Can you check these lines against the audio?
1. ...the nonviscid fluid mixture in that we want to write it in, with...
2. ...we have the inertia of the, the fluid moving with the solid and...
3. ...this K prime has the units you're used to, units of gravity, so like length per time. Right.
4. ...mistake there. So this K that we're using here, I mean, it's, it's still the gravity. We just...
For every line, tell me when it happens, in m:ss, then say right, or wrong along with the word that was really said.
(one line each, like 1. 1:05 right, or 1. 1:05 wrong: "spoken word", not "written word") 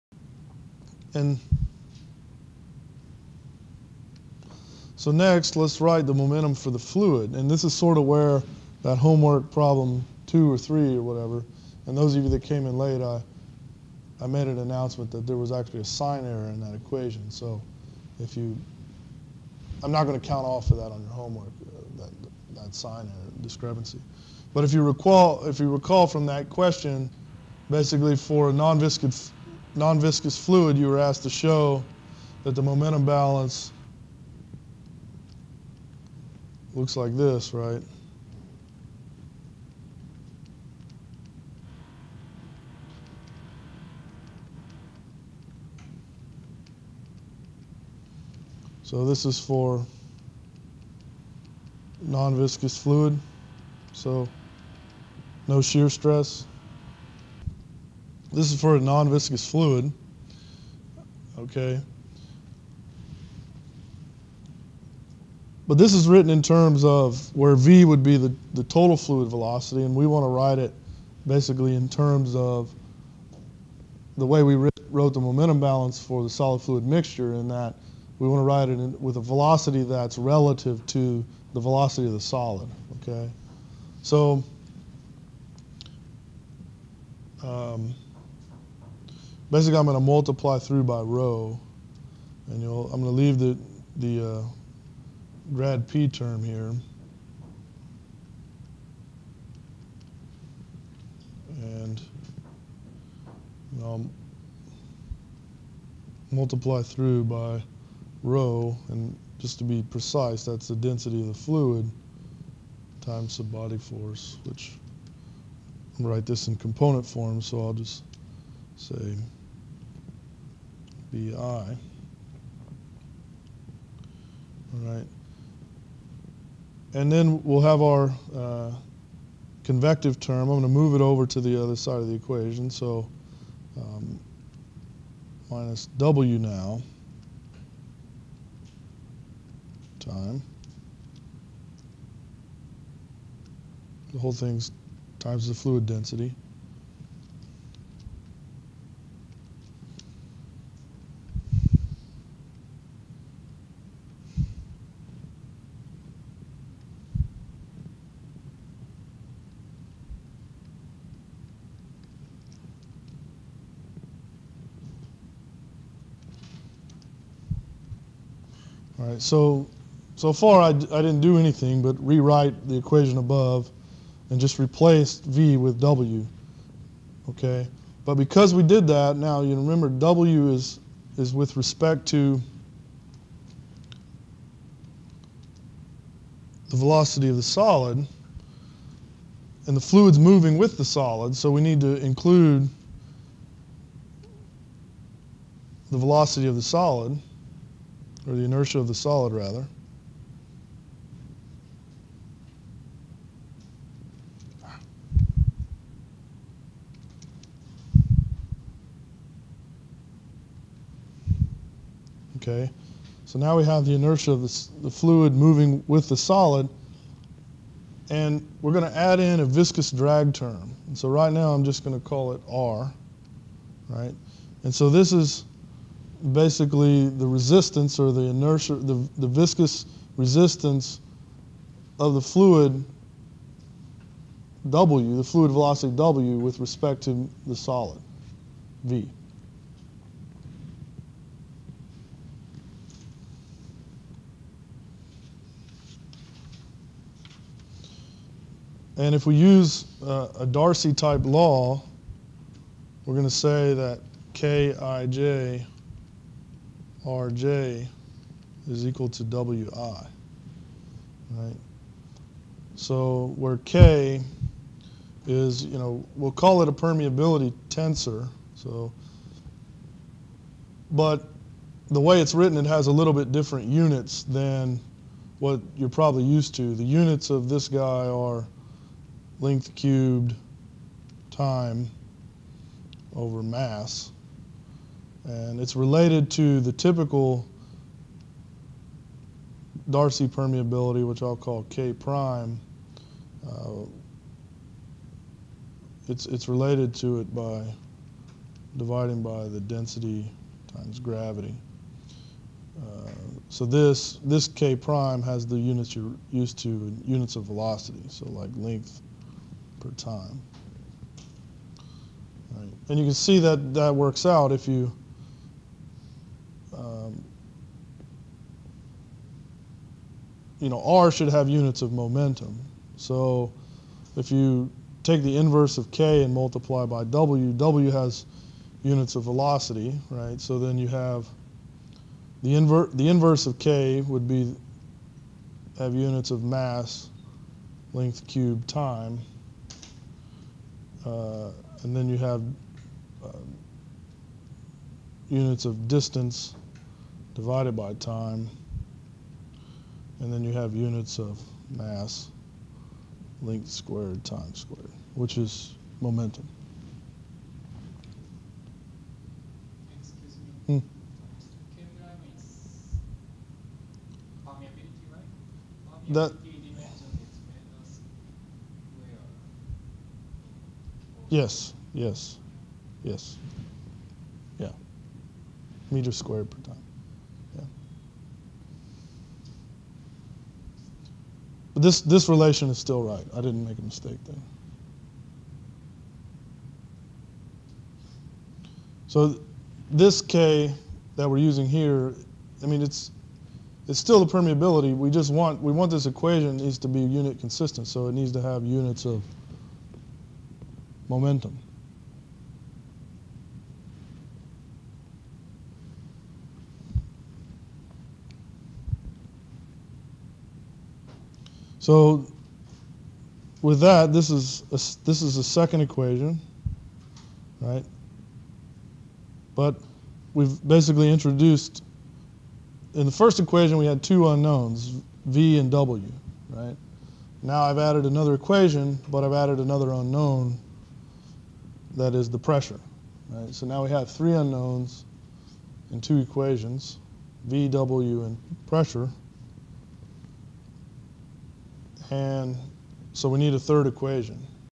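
1. 1:16 wrong: "solid", not "nonviscid"
2. 3:33 right
3. 5:04 wrong: "velocity", not "gravity"
4. 6:23 wrong: "permeability", not "gravity".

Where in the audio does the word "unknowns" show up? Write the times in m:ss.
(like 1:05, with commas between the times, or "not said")
7:04, 7:09, 7:14.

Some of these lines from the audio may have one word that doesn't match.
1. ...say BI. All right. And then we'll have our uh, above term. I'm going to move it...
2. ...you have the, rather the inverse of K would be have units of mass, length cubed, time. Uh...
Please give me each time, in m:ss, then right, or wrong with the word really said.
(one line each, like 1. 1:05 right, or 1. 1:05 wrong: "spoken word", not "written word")
1. 1:58 wrong: "convective", not "above"
2. 5:30 wrong: "inver", not "rather".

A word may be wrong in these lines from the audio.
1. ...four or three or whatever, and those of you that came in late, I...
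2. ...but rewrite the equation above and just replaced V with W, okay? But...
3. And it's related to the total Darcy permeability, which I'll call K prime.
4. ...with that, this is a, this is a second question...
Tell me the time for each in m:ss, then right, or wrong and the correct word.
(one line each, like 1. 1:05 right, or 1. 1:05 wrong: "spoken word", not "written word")
1. 0:10 wrong: "two", not "four"
2. 2:51 right
3. 4:45 wrong: "typical", not "total"
4. 6:53 wrong: "equation", not "question".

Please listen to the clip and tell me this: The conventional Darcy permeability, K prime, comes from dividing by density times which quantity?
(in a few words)
Gravity.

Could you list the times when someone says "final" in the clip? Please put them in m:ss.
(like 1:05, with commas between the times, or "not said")
not said.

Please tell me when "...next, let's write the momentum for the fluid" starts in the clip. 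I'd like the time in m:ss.
0:05.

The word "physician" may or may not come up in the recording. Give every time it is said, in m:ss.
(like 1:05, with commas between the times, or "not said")
not said.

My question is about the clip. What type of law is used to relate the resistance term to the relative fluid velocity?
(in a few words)
Darcy type law.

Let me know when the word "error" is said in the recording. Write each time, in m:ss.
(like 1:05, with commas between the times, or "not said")
0:16, 0:23.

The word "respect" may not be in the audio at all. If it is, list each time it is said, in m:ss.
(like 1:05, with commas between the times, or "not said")
3:01, 3:56.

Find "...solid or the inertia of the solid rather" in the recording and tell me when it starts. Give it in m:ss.
3:16.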